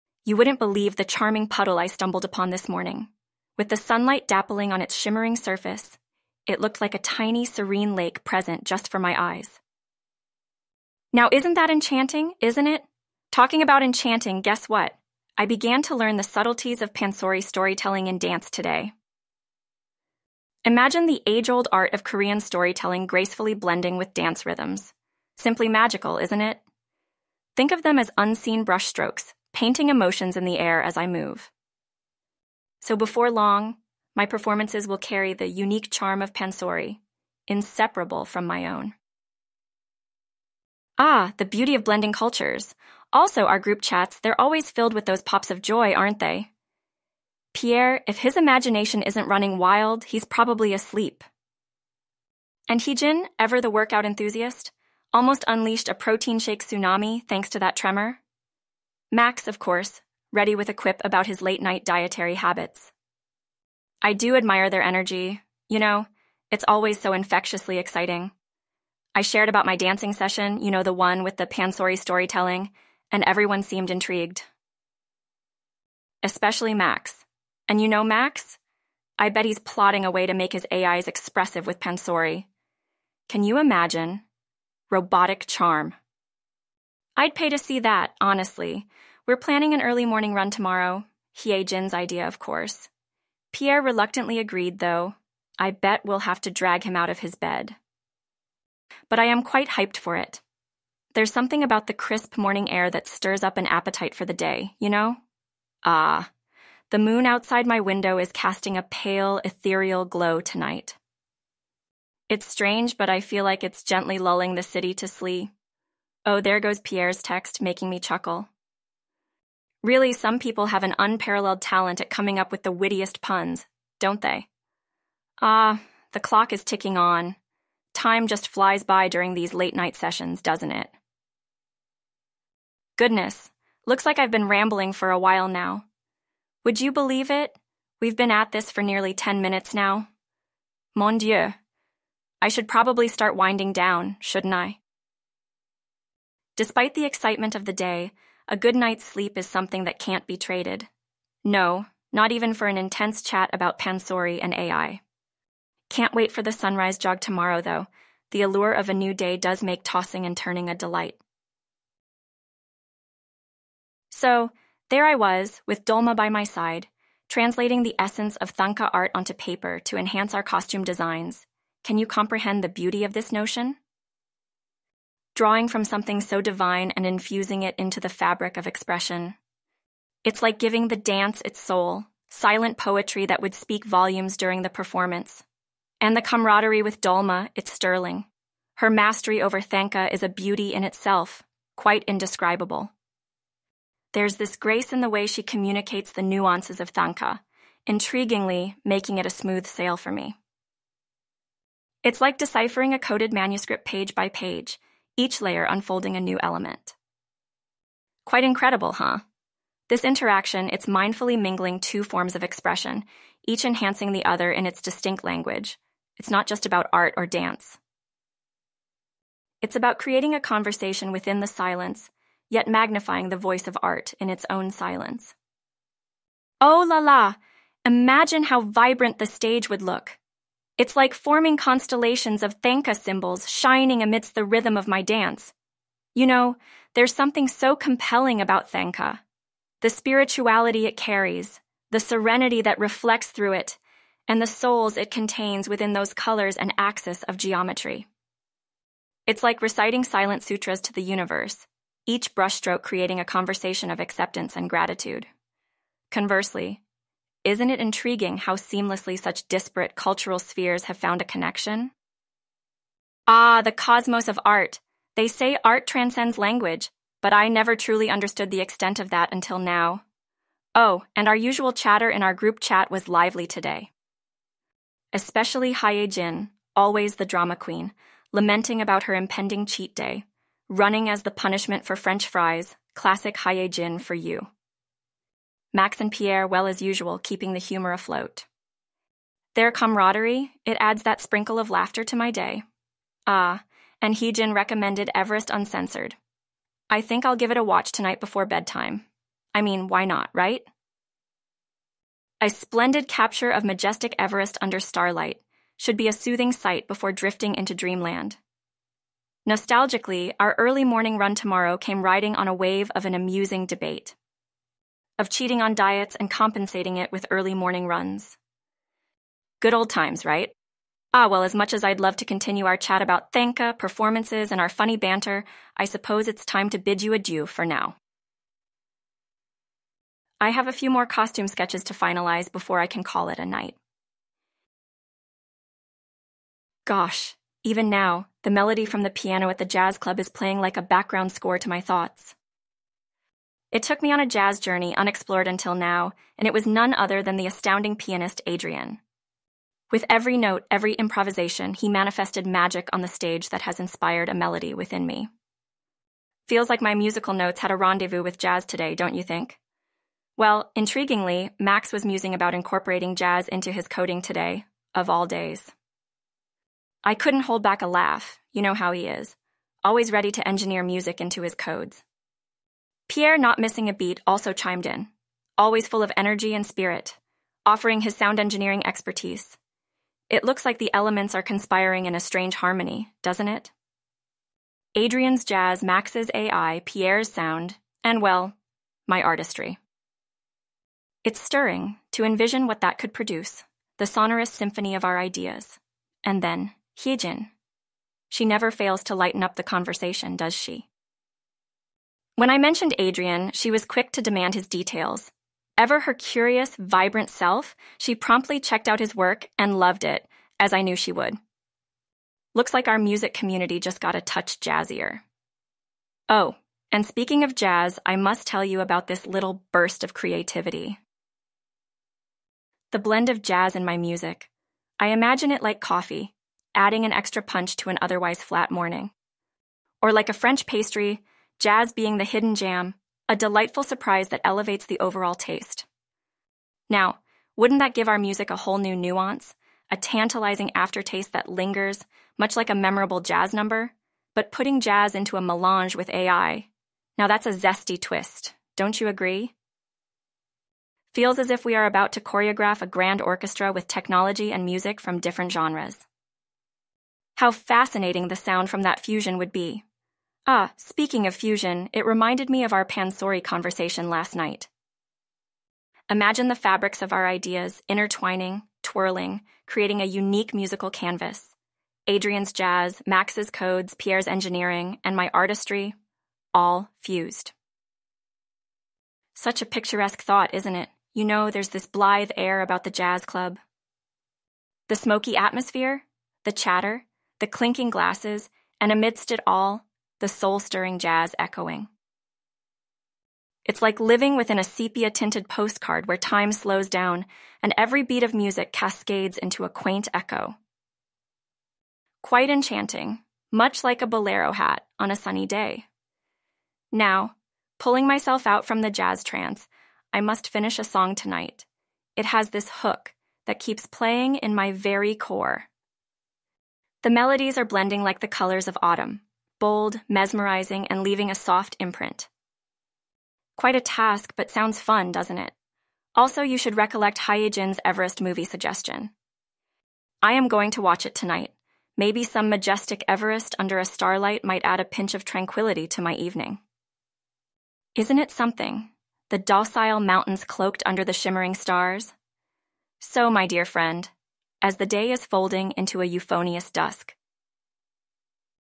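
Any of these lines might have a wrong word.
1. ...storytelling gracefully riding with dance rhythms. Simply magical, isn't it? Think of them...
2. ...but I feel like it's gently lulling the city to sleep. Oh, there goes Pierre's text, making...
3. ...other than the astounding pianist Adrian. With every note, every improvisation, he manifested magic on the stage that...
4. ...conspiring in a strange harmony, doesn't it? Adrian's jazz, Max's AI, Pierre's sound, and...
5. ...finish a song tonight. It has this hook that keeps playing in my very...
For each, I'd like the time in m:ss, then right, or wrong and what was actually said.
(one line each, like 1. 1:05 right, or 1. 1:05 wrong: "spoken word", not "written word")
1. 0:22 wrong: "blending", not "riding"
2. 1:52 right
3. 5:46 right
4. 6:21 right
5. 8:30 right.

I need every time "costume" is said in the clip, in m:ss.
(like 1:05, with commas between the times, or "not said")
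2:50, 5:31.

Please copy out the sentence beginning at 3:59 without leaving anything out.
The spirituality it carries, the serenity that reflects through it, and the souls it contains within those colors and axis of geometry.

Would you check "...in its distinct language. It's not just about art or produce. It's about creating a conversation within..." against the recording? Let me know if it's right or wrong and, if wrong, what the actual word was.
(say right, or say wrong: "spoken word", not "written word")
wrong: "dance", not "produce".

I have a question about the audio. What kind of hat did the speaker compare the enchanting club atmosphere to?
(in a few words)
bolero hat.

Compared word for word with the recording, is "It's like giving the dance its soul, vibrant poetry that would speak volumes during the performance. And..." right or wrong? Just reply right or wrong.
wrong.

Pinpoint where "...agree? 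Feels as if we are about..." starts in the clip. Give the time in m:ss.
7:29.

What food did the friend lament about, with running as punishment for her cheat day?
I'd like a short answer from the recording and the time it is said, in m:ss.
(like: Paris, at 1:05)
french fries, at 4:41.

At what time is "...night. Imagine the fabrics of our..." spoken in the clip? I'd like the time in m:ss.
7:44.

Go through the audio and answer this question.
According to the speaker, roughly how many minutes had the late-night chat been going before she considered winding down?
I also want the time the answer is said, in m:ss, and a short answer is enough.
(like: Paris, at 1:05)
10, at 2:18.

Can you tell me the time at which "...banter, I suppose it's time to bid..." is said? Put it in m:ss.
5:24.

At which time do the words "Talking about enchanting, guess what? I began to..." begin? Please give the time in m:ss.
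0:13.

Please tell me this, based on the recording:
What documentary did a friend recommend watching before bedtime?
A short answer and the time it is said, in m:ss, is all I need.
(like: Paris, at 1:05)
Everest Uncensored, at 4:55.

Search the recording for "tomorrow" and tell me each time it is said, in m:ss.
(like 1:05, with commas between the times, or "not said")
1:30, 2:37, 5:11.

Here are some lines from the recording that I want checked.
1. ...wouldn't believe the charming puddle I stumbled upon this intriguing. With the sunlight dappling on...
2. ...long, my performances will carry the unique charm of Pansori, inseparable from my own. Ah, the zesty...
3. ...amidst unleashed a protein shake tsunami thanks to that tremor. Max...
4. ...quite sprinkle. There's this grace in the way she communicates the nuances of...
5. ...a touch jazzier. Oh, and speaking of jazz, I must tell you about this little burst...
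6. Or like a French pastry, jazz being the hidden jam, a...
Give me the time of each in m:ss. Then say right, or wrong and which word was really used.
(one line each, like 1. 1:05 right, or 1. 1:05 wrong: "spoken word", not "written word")
1. 0:00 wrong: "morning", not "intriguing"
2. 0:33 wrong: "beauty", not "zesty"
3. 0:55 wrong: "almost", not "amidst"
4. 3:11 wrong: "indescribable", not "sprinkle"
5. 6:54 right
6. 7:10 right.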